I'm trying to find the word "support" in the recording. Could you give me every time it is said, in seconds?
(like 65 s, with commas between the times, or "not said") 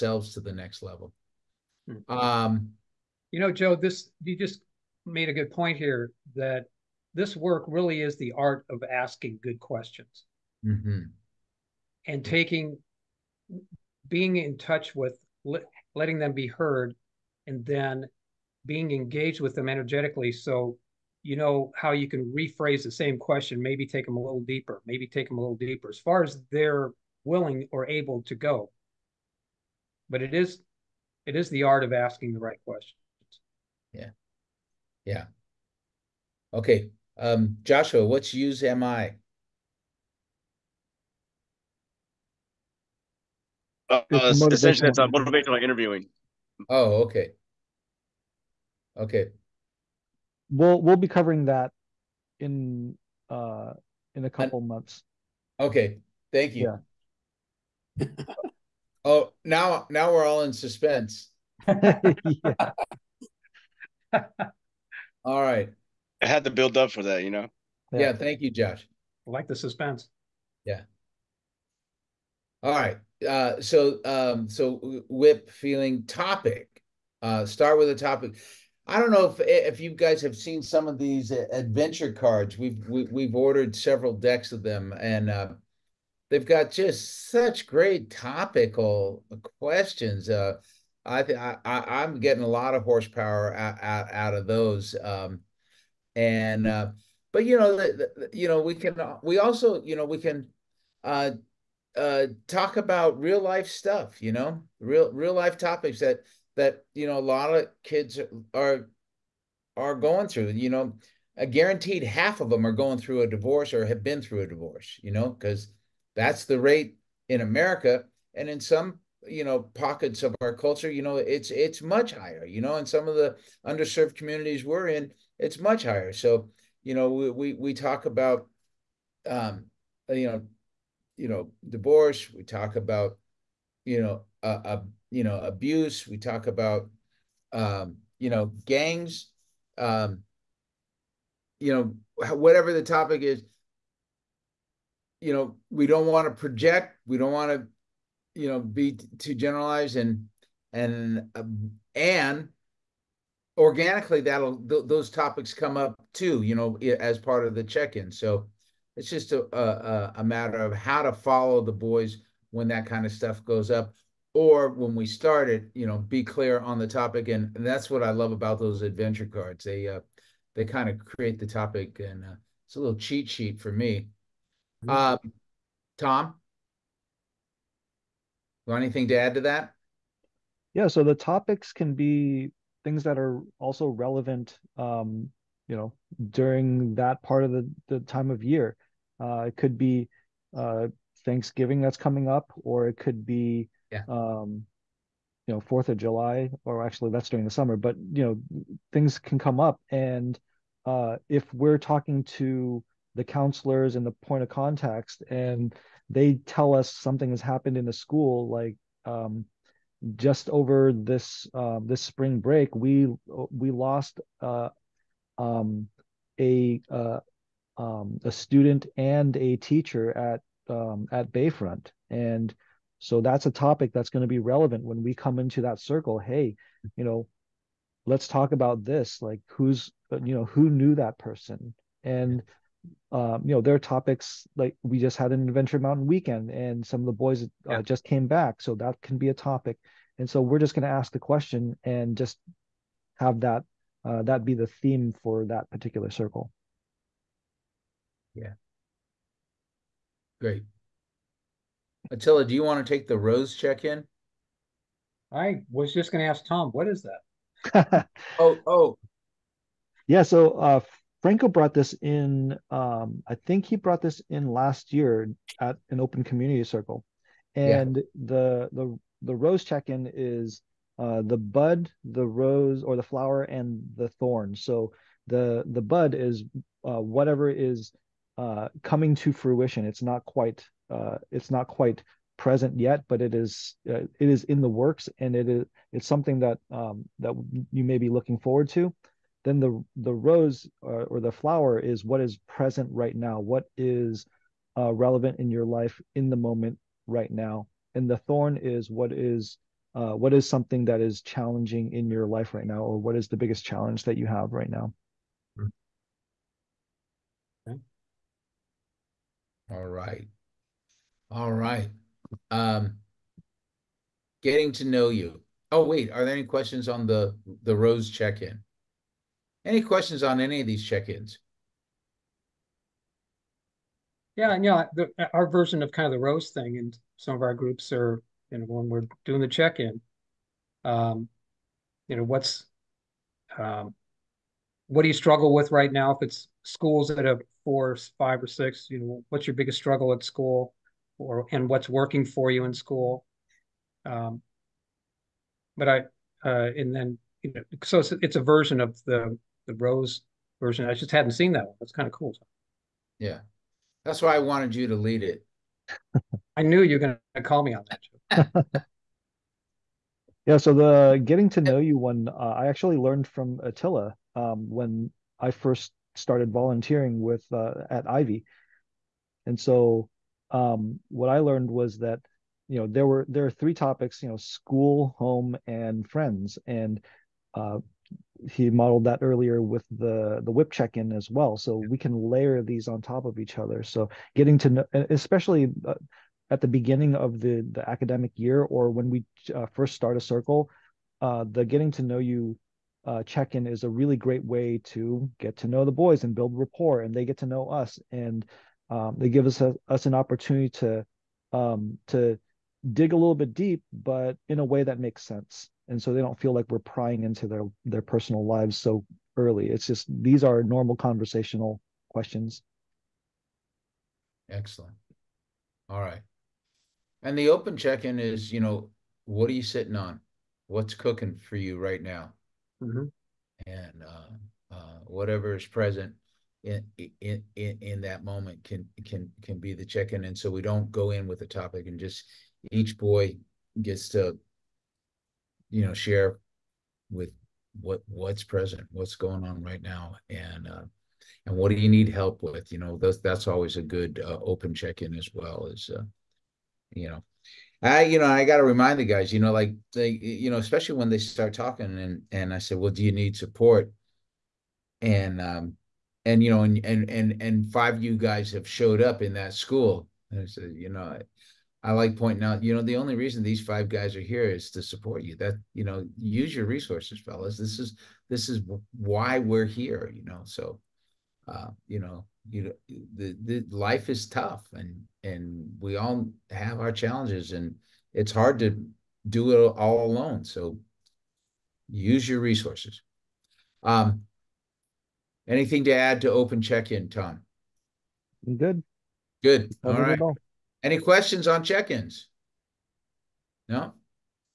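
453 s, 464 s.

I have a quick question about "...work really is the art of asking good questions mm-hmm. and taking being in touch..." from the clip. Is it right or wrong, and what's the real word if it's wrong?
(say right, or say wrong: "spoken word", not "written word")
right.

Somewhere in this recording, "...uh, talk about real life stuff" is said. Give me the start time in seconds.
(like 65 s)
101 s.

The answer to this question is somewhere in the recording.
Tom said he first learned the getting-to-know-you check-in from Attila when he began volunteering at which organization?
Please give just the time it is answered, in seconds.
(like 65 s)
368 s.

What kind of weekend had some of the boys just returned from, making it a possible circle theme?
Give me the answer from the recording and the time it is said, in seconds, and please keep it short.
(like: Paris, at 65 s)
Adventure Mountain weekend, at 235 s.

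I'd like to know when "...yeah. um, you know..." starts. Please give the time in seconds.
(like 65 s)
193 s.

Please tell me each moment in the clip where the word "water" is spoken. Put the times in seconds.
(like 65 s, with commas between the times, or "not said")
not said.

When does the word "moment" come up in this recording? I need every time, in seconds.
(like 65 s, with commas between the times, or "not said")
296 s, 428 s.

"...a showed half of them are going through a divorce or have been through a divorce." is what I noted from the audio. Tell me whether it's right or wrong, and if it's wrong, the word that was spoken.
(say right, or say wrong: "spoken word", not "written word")
wrong: "guaranteed", not "showed".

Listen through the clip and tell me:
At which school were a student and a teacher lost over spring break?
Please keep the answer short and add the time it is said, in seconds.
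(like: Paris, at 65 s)
Bayfront, at 221 s.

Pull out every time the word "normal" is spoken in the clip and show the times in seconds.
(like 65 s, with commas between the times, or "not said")
410 s.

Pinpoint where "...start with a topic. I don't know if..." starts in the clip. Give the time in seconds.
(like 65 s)
77 s.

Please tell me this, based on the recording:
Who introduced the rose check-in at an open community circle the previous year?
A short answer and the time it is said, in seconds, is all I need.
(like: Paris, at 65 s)
Franco, at 261 s.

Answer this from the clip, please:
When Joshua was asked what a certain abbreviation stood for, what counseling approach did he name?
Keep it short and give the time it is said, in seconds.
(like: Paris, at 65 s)
motivational interviewing, at 45 s.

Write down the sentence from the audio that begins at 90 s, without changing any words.
Uh, I, th- I, I am getting a lot of horsepower out out, out of those.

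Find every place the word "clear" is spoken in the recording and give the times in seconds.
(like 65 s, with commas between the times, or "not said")
166 s.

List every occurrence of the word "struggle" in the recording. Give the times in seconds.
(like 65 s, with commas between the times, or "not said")
335 s, 339 s.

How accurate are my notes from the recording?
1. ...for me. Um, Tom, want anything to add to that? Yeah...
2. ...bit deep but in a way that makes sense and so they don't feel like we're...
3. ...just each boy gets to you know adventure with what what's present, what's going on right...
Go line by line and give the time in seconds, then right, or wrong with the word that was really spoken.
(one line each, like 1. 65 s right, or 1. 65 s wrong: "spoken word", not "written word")
1. 173 s right
2. 403 s right
3. 431 s wrong: "share", not "adventure".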